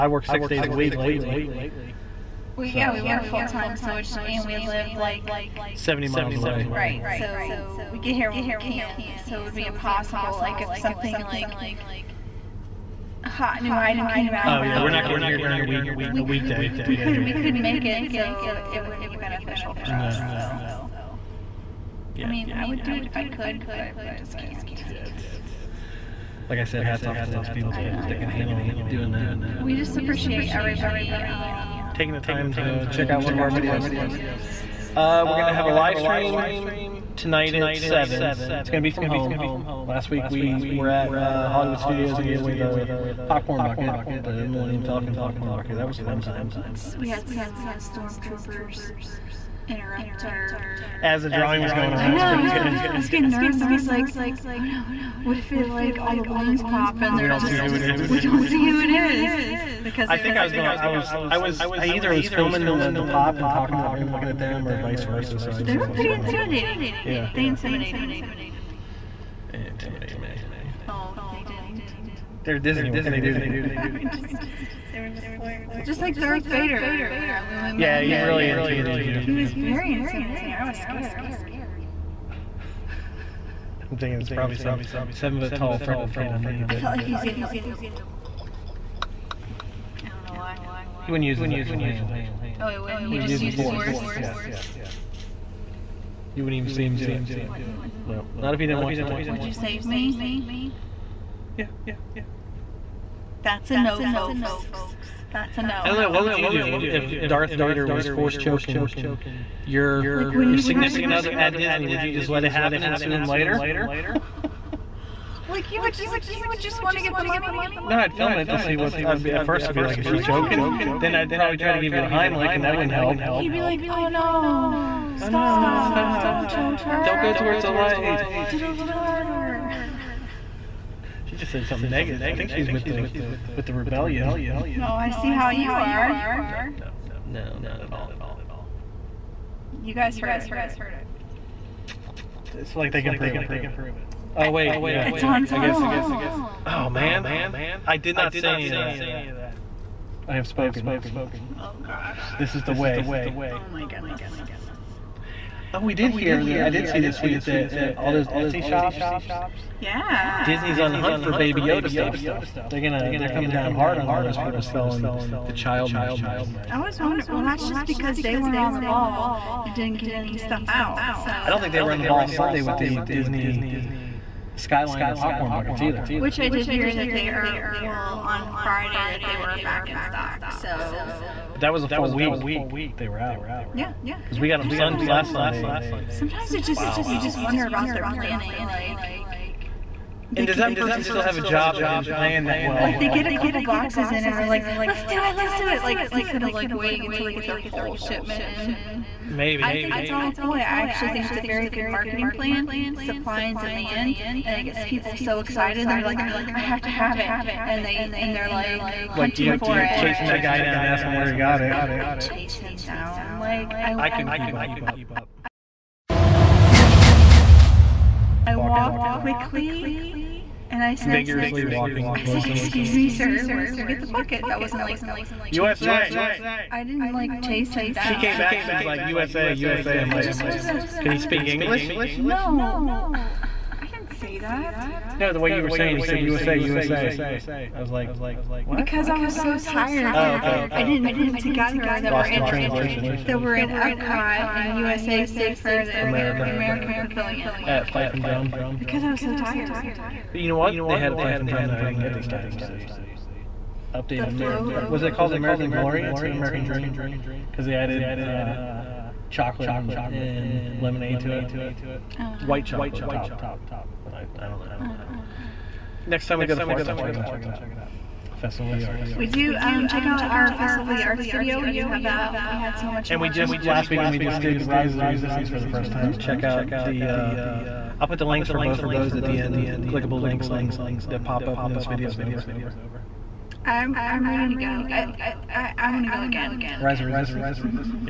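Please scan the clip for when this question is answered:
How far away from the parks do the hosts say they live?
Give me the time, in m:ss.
0:05.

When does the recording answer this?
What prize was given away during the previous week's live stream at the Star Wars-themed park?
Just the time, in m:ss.
0:44.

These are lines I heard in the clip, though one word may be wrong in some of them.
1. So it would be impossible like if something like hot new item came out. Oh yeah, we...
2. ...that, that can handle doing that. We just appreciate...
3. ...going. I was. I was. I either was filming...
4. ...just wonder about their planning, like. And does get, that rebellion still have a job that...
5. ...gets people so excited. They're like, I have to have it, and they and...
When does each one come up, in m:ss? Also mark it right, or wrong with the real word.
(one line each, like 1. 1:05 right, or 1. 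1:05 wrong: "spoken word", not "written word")
1. 0:09 right
2. 0:27 right
3. 1:00 right
4. 3:07 wrong: "person", not "rebellion"
5. 3:24 right.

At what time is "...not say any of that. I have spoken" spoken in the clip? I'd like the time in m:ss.
2:28.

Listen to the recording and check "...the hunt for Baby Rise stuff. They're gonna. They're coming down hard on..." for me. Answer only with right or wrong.
wrong.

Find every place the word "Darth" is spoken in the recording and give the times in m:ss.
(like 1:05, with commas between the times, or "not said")
1:16, 1:47.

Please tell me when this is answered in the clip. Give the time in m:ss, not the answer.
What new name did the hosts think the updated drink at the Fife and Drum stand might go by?
4:15.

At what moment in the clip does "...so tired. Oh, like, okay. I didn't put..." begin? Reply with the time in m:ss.
3:59.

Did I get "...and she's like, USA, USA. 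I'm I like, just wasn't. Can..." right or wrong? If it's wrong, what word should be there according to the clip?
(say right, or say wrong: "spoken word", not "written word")
right.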